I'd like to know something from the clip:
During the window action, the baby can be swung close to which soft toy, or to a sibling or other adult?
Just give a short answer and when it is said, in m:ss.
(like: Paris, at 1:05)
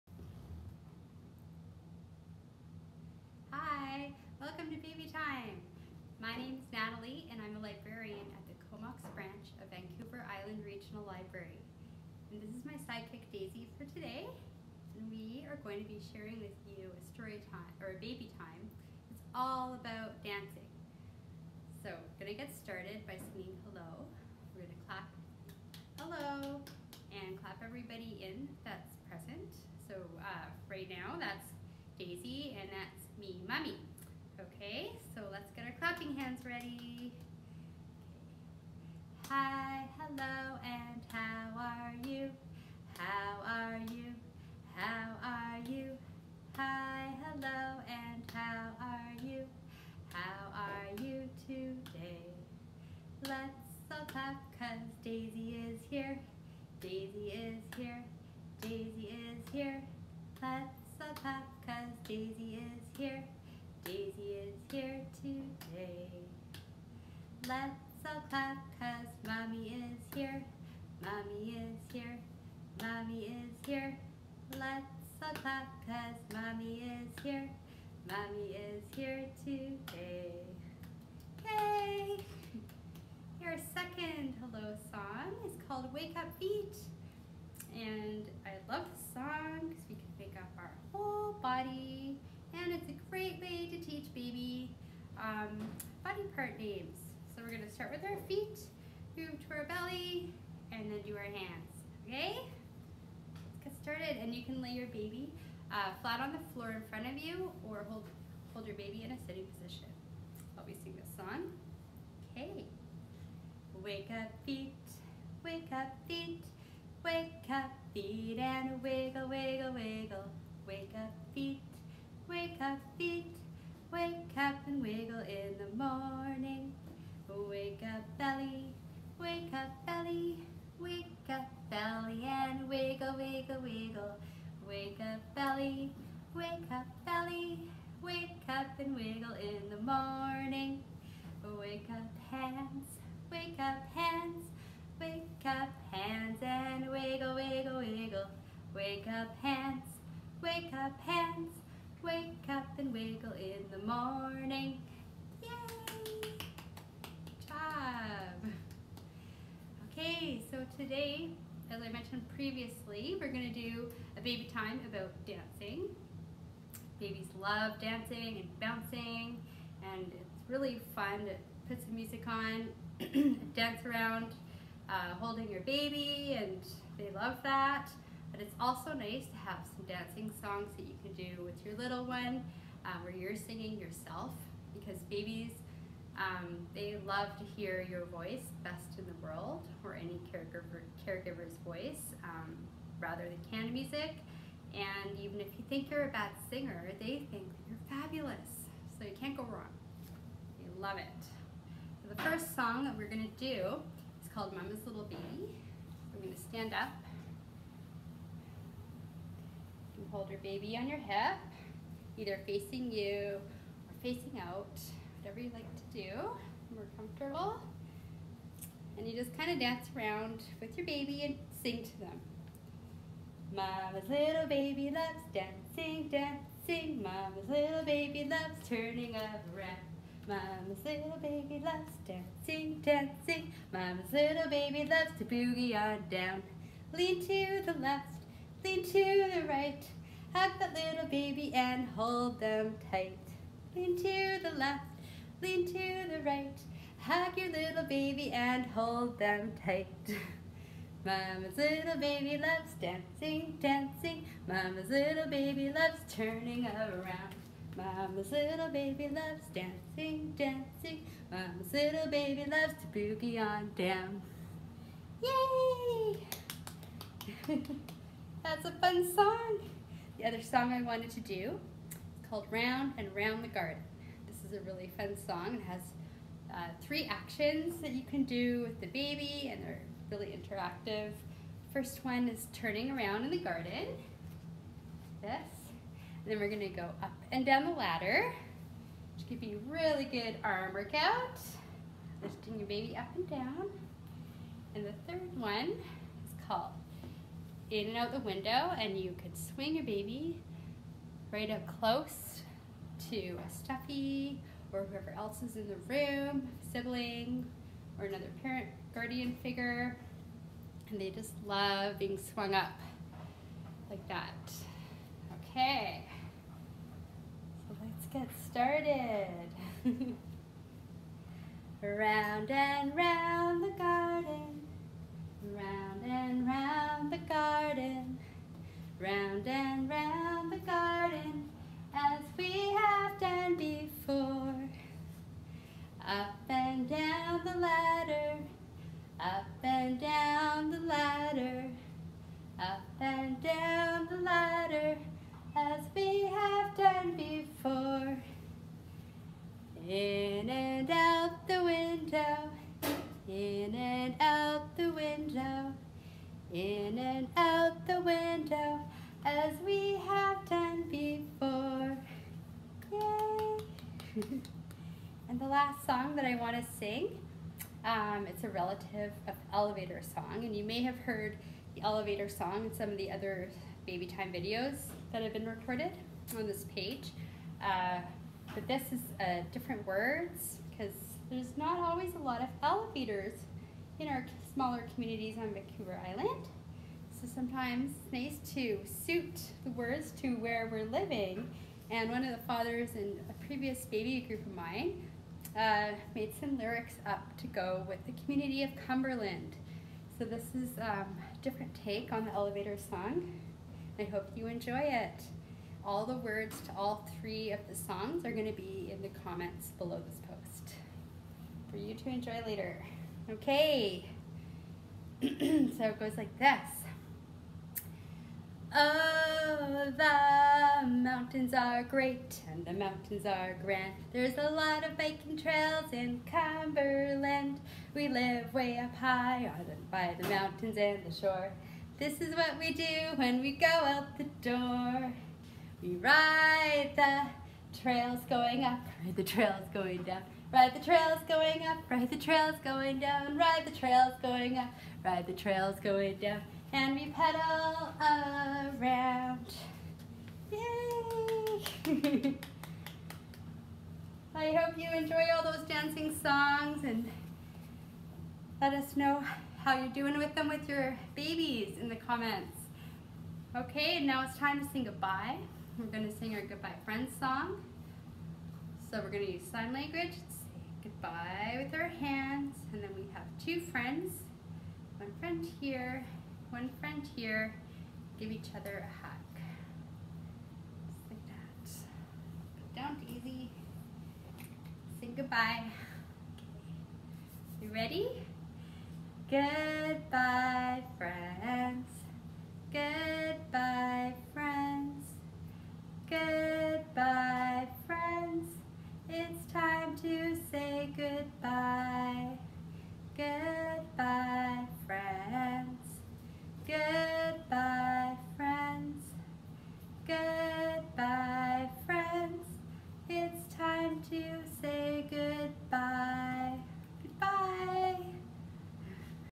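A stuffy, at 5:03.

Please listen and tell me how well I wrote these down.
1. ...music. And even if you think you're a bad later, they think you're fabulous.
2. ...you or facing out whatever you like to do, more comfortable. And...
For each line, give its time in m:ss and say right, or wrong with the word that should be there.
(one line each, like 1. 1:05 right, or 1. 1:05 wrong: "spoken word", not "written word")
1. 3:13 wrong: "singer", not "later"
2. 3:32 right.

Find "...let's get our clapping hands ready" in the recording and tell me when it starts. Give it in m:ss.
0:35.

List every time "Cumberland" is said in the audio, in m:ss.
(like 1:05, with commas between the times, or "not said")
6:38, 7:06.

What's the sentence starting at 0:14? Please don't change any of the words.
And we are going to be sharing with you a story time or a baby time.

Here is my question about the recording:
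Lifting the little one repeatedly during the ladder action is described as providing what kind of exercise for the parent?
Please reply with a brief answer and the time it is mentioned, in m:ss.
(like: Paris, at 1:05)
Arm workout, at 4:50.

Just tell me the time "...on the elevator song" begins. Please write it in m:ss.
6:42.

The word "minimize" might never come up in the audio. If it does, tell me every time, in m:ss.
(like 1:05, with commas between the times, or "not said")
not said.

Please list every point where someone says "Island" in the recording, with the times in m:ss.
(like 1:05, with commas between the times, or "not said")
0:10, 6:26.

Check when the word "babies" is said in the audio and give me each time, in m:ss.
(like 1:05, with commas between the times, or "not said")
2:46, 3:05, 7:41.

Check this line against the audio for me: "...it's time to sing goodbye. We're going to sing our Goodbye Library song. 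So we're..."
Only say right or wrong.
wrong.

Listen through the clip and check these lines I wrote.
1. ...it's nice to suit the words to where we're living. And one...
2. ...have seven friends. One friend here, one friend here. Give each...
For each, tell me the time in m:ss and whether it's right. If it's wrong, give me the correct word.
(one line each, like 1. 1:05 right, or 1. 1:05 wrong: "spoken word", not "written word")
1. 6:27 right
2. 7:53 wrong: "two", not "seven".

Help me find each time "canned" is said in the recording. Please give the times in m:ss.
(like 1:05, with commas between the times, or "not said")
3:13.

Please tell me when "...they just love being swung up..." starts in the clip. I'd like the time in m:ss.
5:11.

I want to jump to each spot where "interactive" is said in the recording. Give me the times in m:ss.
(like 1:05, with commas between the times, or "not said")
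4:40.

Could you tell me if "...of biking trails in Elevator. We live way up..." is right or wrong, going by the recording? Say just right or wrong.
wrong.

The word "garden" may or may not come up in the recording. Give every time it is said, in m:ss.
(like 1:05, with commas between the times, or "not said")
4:33, 4:43, 5:23.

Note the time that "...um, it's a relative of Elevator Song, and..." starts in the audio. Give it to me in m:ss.
6:07.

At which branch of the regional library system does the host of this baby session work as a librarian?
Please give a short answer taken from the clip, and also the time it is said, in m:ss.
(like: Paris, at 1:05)
Comox, at 0:08.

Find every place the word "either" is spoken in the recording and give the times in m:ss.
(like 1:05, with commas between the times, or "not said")
3:32.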